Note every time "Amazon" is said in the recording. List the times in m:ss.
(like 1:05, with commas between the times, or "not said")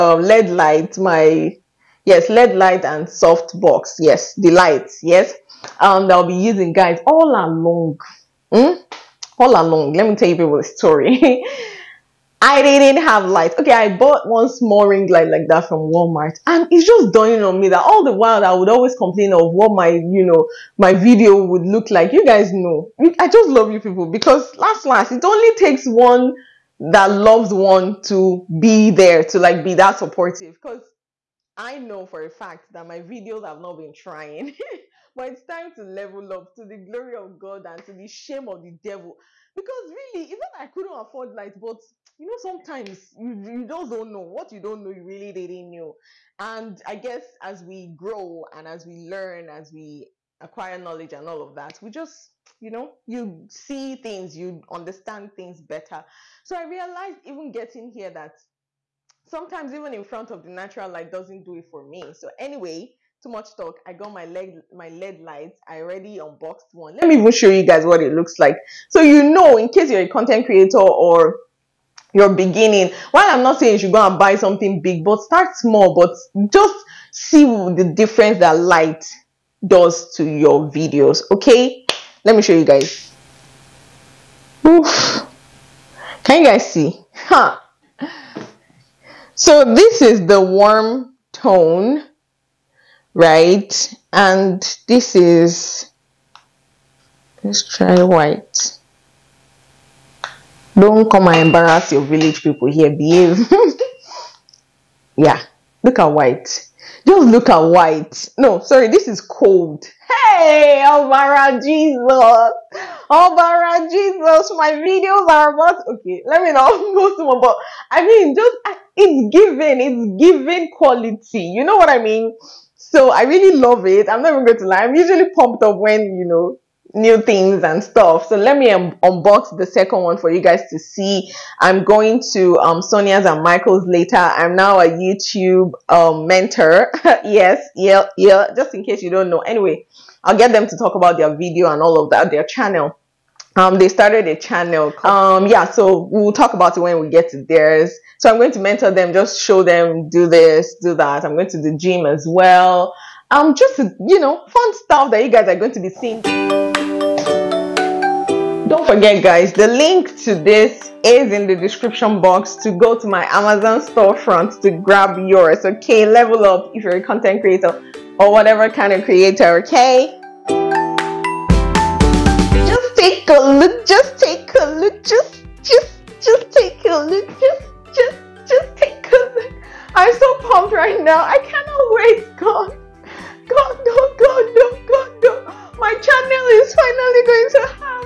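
2:43.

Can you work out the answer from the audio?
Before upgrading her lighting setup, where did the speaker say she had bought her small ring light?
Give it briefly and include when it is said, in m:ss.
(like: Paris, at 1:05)
Walmart, at 0:15.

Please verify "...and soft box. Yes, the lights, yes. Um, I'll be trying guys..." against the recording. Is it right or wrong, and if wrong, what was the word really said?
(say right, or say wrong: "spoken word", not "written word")
wrong: "using", not "trying".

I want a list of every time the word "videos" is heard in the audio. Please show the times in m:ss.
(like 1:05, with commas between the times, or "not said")
0:20, 0:33, 1:20, 1:54, 2:21.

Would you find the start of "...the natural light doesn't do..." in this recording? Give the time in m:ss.
1:00.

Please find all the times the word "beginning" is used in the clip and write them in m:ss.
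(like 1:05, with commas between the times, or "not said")
1:12.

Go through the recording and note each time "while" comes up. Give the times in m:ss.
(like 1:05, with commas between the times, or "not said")
0:18, 1:13.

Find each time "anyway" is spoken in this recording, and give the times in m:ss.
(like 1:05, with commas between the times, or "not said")
1:02, 2:19.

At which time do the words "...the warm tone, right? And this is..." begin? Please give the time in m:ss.
1:30.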